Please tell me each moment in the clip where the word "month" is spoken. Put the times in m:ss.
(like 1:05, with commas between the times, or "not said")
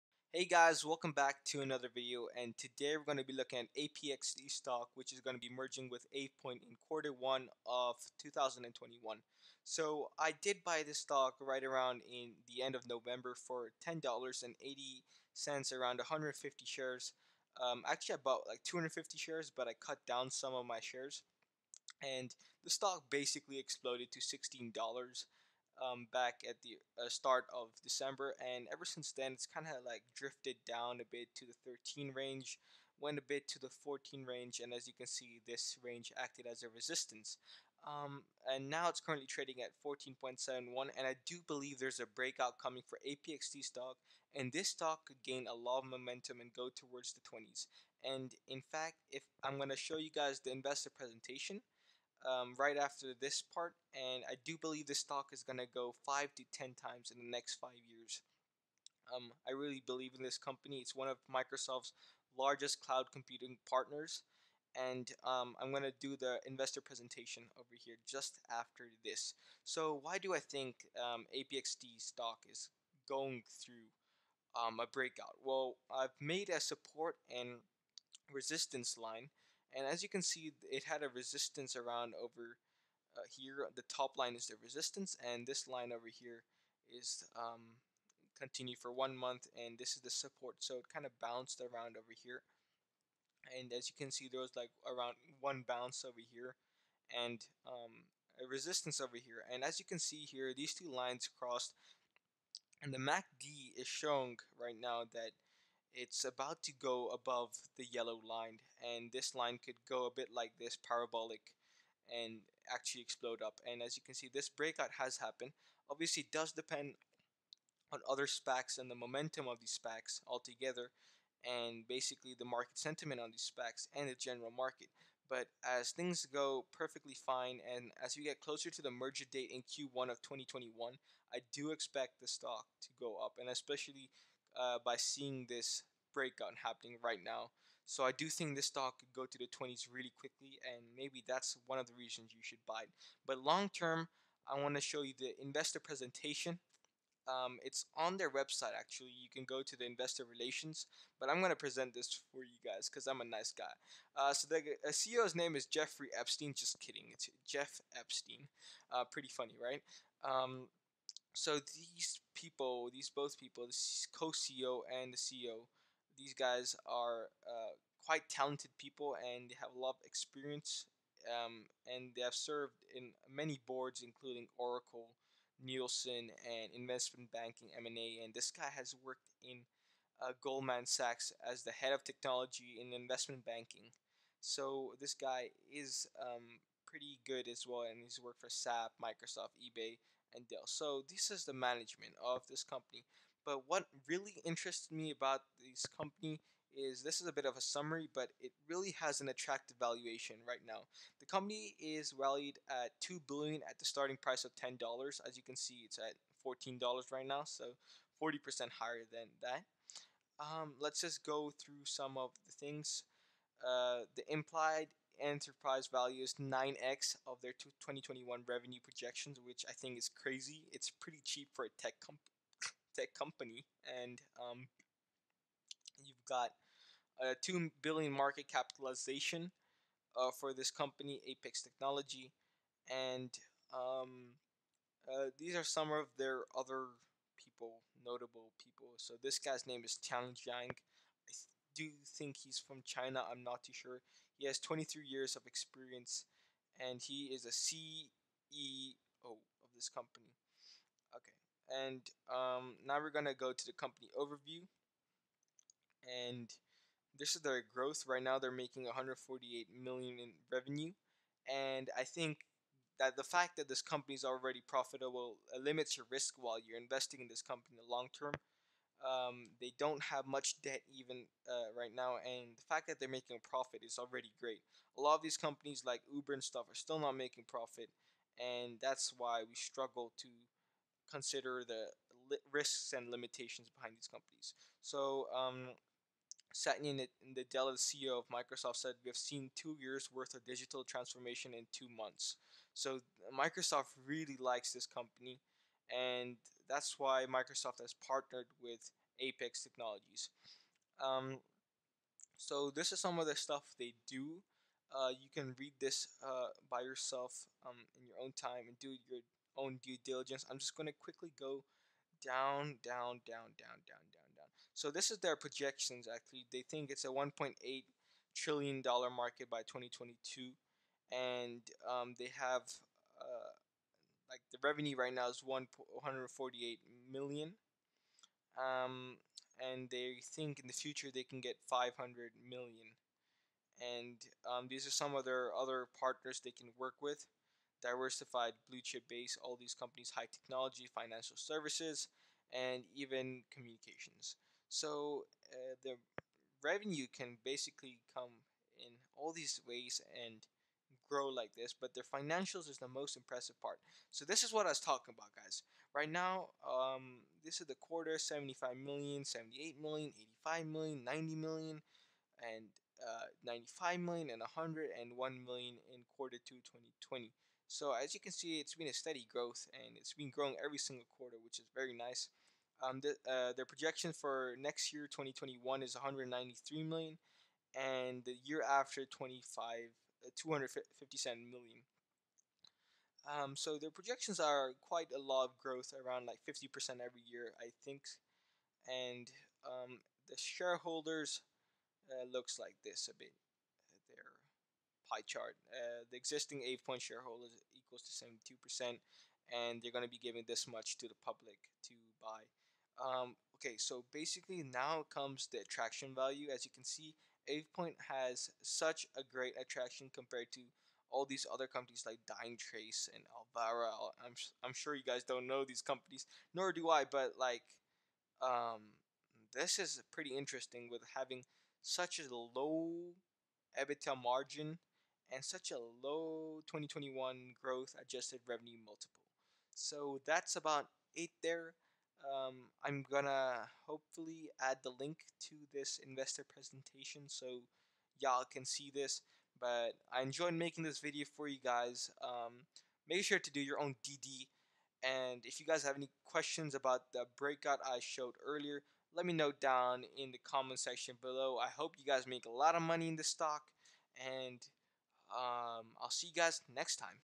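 1:29, 4:51.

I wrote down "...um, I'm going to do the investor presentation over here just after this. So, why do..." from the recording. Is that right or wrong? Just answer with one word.
right.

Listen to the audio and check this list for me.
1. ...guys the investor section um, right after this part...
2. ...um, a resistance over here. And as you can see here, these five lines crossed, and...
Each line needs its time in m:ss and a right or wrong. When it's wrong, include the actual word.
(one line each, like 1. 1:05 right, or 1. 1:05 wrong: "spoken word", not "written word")
1. 0:50 wrong: "presentation", not "section"
2. 1:37 wrong: "two", not "five".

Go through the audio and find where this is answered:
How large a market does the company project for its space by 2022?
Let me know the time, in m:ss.
5:17.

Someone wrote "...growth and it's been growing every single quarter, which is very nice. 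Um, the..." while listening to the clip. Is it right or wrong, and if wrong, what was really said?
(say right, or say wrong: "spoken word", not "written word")
right.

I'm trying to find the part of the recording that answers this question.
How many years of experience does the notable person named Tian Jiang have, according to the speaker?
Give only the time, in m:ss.
4:04.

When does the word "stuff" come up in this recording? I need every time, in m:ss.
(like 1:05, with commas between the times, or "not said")
4:36, 5:03.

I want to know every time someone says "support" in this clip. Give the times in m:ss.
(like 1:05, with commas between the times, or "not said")
1:16, 1:30.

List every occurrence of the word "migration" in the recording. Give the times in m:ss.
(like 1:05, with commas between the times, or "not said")
not said.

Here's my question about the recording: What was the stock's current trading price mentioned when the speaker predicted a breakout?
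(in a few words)
14.71.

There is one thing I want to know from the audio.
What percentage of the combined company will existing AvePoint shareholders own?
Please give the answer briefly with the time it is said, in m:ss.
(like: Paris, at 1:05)
72%, at 6:38.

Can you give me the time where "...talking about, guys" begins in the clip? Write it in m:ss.
5:54.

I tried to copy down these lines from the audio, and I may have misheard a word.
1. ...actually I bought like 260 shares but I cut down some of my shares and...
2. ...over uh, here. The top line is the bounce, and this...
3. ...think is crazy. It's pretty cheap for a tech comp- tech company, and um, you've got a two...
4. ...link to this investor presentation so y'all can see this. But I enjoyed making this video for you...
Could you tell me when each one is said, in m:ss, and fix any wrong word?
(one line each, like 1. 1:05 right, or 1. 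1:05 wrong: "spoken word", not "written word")
1. 0:17 wrong: "250", not "260"
2. 1:22 wrong: "resistance", not "bounce"
3. 3:39 right
4. 7:14 right.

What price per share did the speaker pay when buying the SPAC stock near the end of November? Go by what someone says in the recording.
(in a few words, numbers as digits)
$10.80.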